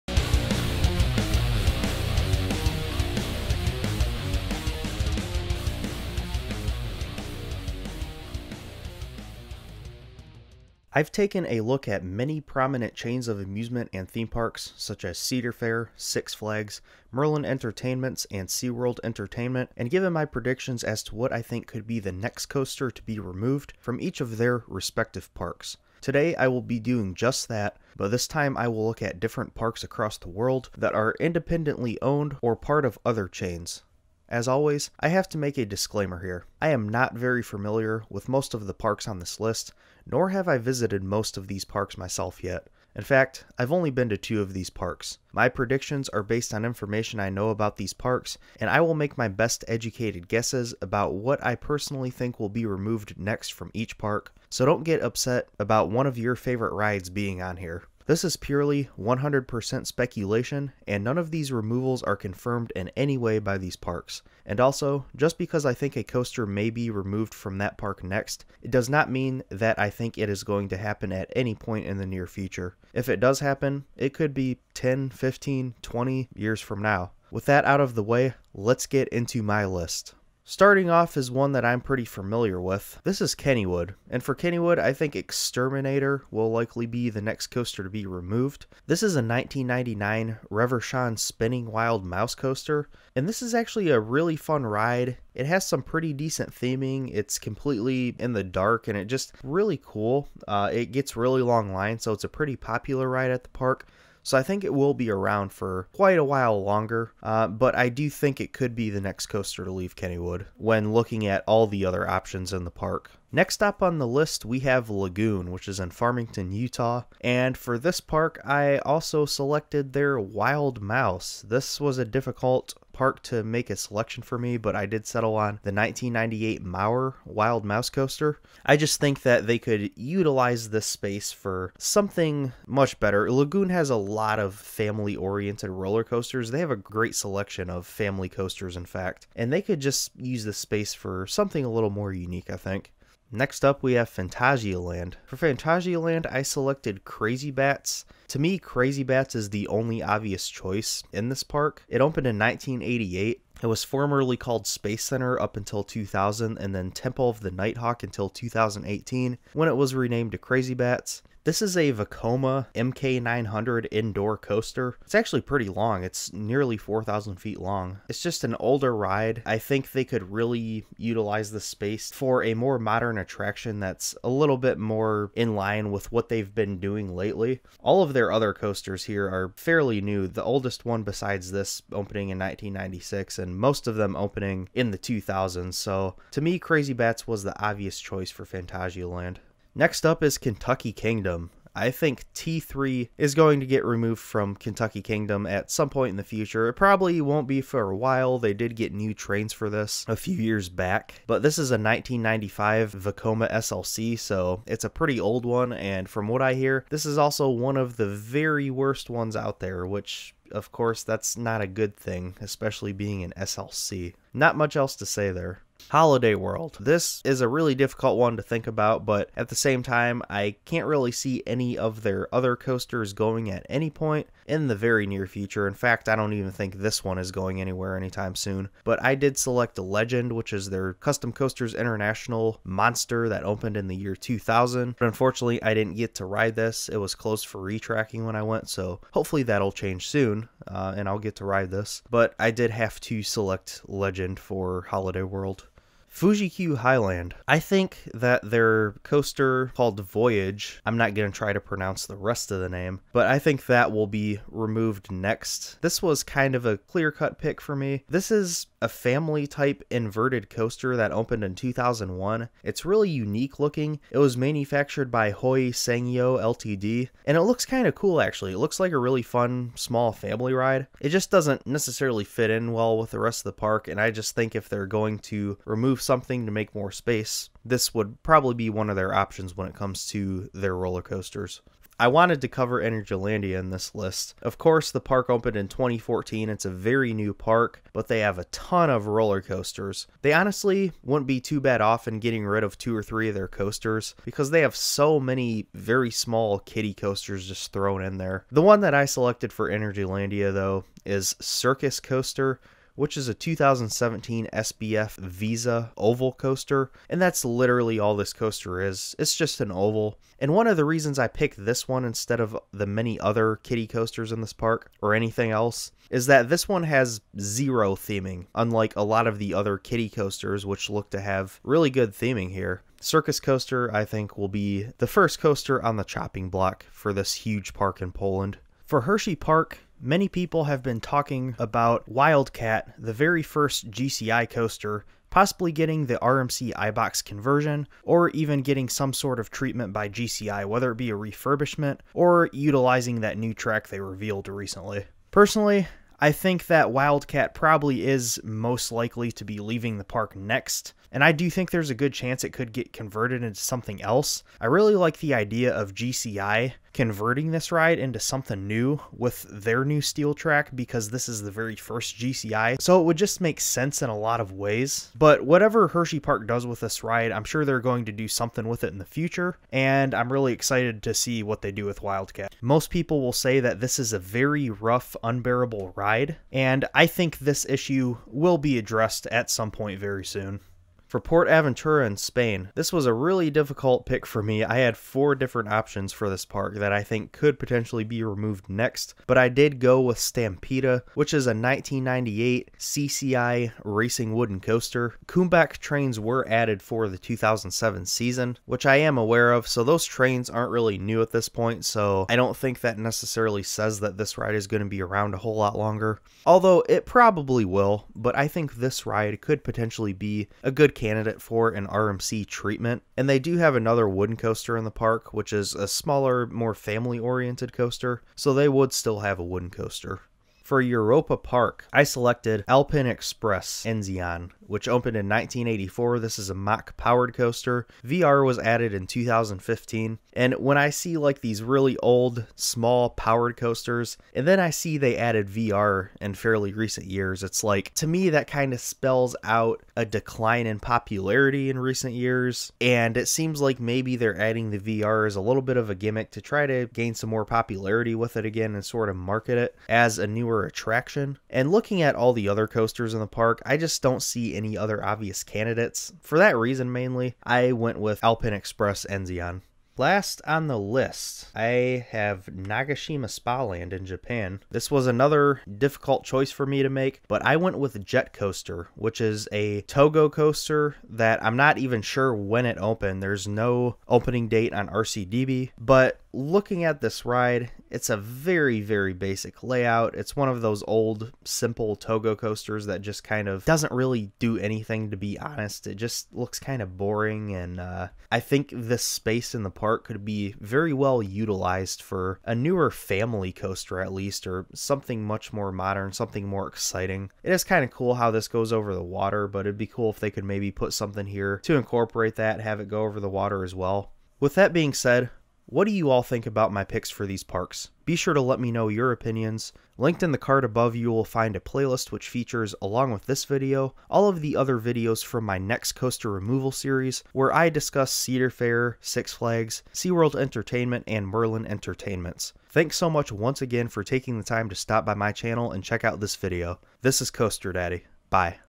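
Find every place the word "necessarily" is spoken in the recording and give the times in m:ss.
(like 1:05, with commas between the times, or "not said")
4:31, 6:42.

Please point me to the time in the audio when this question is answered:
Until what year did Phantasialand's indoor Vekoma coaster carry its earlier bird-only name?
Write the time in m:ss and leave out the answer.
2:38.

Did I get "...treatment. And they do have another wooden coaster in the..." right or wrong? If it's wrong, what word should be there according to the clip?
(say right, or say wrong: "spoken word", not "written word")
right.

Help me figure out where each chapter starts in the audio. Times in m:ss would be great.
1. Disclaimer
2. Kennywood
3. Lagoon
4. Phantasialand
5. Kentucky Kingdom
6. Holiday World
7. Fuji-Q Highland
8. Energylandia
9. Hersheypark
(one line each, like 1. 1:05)
1. 0:33
2. 1:20
3. 1:53
4. 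2:23
5. 3:09
6. 3:35
7. 4:06
8. 4:41
9. 5:28.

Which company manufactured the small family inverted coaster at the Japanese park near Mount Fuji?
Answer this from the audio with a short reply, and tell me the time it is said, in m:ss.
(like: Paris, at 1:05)
Hoei Sangyo Ltd., at 4:25.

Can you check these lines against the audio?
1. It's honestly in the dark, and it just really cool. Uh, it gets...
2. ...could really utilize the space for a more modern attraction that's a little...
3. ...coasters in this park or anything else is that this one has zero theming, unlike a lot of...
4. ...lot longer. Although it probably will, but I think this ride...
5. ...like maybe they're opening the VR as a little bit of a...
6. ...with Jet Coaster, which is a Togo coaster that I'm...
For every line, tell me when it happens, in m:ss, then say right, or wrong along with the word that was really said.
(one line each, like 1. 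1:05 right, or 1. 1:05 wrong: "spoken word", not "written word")
1. 1:37 wrong: "completely", not "honestly"
2. 2:50 right
3. 5:13 right
4. 6:45 right
5. 7:23 wrong: "adding", not "opening"
6. 7:47 right.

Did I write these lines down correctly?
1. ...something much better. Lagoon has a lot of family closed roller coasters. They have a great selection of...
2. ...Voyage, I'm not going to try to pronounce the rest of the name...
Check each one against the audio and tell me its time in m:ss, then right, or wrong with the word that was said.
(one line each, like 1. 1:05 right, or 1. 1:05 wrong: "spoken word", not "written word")
1. 2:11 wrong: "oriented", not "closed"
2. 4:10 right.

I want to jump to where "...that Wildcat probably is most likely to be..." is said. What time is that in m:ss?
5:46.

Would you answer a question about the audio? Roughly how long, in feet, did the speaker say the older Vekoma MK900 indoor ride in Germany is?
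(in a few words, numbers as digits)
nearly 4,000 feet.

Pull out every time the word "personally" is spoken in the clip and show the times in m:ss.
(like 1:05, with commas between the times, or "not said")
0:51, 5:45.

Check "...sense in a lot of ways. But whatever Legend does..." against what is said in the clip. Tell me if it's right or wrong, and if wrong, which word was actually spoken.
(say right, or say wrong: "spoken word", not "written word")
wrong: "Hersheypark", not "Legend".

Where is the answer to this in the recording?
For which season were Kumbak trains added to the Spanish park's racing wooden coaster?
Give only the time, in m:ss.
6:37.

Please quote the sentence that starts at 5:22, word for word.
Circus Coaster, I think, will be the first coaster on the chopping block for this huge park in Poland.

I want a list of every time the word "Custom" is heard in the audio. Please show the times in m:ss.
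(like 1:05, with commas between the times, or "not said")
3:50.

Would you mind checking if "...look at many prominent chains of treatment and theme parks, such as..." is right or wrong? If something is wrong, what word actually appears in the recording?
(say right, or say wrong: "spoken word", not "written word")
wrong: "amusement", not "treatment".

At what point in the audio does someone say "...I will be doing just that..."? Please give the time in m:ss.
0:26.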